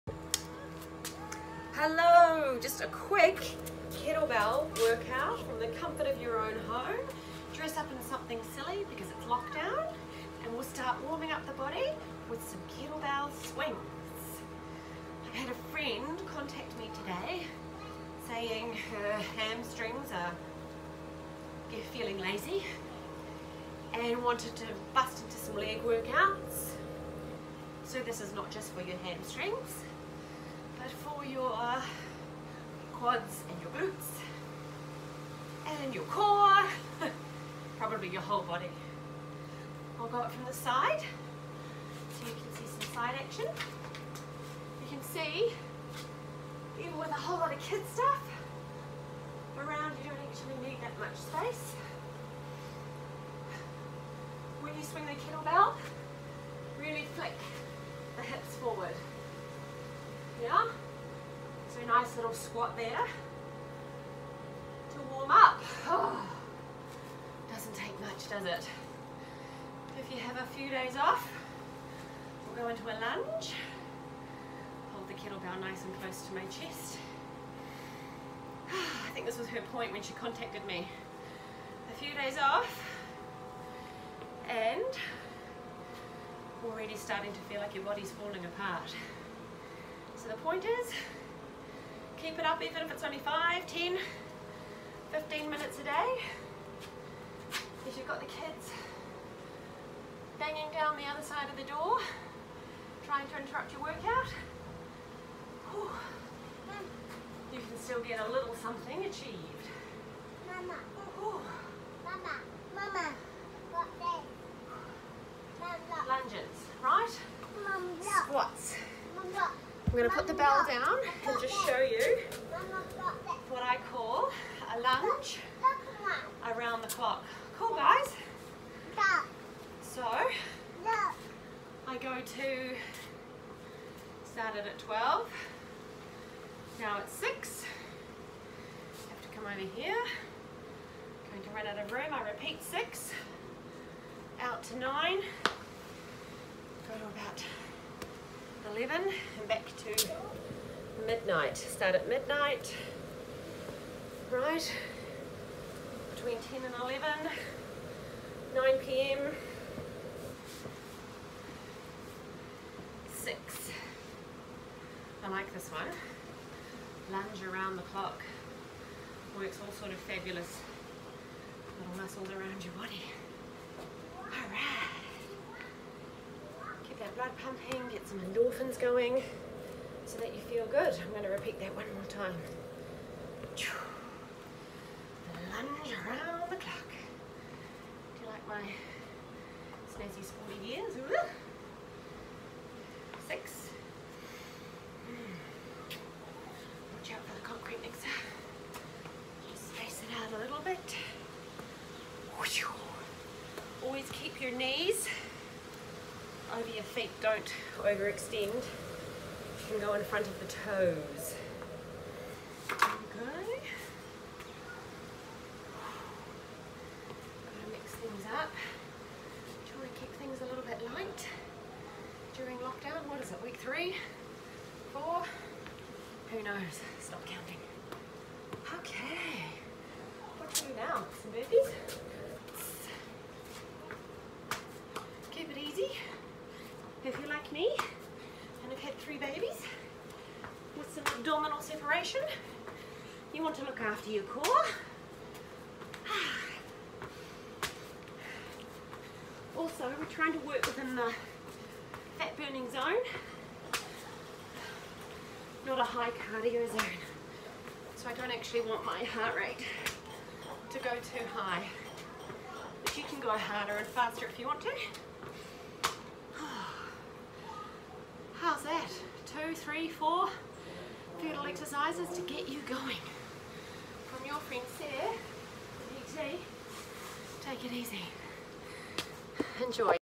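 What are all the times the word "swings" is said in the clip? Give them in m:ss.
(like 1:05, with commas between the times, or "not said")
0:13, 0:54.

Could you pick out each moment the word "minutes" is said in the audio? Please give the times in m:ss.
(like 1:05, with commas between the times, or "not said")
1:35.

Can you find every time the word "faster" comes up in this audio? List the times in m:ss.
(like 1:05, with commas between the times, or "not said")
4:23.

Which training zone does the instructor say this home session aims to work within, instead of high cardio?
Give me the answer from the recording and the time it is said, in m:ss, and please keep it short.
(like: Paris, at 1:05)
Fat burning zone, at 4:12.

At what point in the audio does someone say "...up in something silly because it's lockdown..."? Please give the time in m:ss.
0:07.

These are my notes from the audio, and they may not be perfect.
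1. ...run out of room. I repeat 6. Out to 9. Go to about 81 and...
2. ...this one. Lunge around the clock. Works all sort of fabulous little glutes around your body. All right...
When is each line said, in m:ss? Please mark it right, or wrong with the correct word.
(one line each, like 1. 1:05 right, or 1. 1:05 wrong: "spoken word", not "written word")
1. 2:21 wrong: "11", not "81"
2. 2:45 wrong: "muscles", not "glutes".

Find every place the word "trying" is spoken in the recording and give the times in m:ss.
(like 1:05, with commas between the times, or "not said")
1:43, 4:10.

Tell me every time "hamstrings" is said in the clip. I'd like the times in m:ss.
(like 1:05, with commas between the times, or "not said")
0:19, 0:28.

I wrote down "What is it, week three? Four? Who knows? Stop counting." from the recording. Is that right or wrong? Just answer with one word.
right.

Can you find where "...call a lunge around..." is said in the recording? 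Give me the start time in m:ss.
2:03.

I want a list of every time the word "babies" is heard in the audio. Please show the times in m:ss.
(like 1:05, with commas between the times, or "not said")
3:59.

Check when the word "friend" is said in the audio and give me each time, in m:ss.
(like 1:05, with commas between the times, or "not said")
0:15, 4:34.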